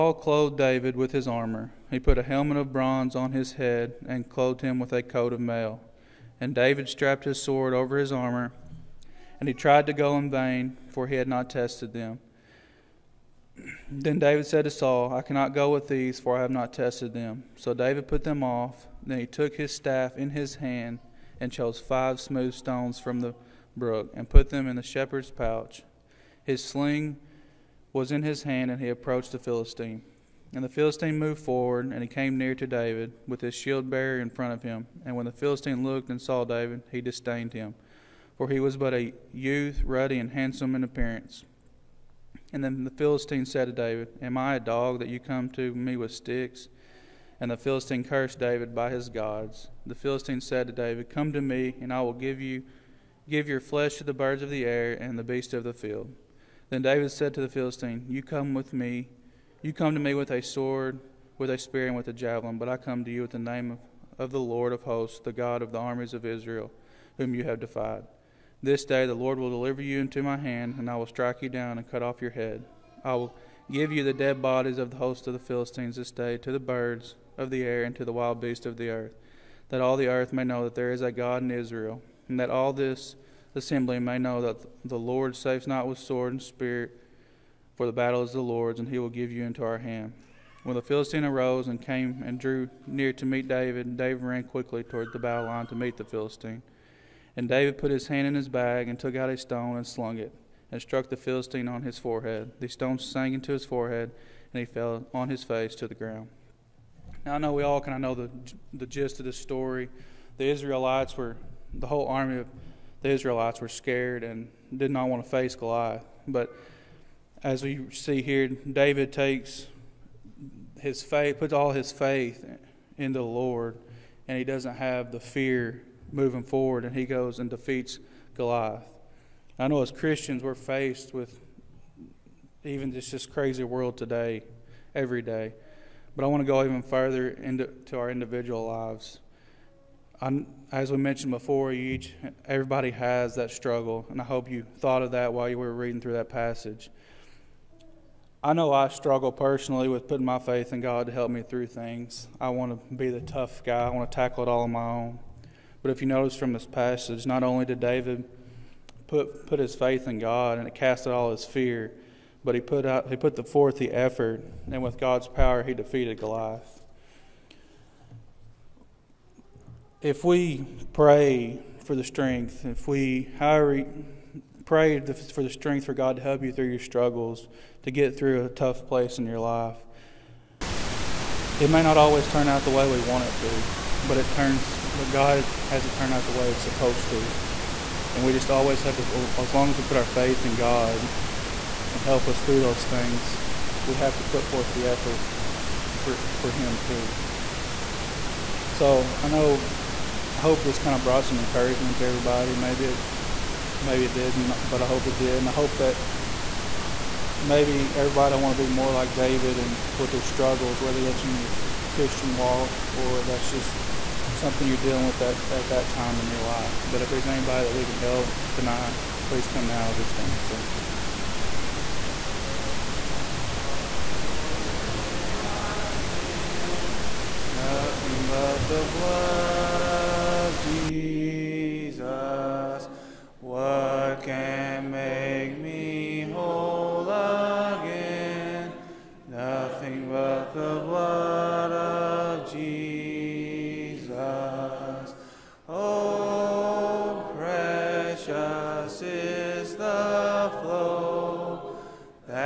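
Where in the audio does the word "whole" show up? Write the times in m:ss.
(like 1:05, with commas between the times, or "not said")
1:51.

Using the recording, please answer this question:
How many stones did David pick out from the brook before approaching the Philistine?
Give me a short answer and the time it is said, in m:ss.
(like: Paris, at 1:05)
5, at 0:21.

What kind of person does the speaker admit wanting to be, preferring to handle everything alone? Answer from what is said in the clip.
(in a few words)
The tough guy.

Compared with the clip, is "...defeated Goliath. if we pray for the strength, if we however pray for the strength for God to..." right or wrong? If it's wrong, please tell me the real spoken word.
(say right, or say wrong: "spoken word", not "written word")
right.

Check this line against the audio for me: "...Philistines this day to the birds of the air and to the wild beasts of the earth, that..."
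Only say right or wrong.
right.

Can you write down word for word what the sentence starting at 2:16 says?
But I want to go even further into our individual lives.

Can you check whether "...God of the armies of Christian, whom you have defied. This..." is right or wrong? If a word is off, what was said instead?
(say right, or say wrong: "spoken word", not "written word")
wrong: "Israel", not "Christian".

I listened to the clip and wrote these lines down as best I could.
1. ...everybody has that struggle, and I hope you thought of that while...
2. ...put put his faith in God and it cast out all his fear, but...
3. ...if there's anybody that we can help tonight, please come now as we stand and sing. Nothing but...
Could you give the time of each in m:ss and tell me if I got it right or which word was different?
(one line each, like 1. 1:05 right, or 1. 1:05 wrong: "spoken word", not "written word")
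1. 2:22 right
2. 2:39 right
3. 3:37 right.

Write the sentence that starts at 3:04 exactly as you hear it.
But God has it turn out the way it's supposed to, and we just always have to.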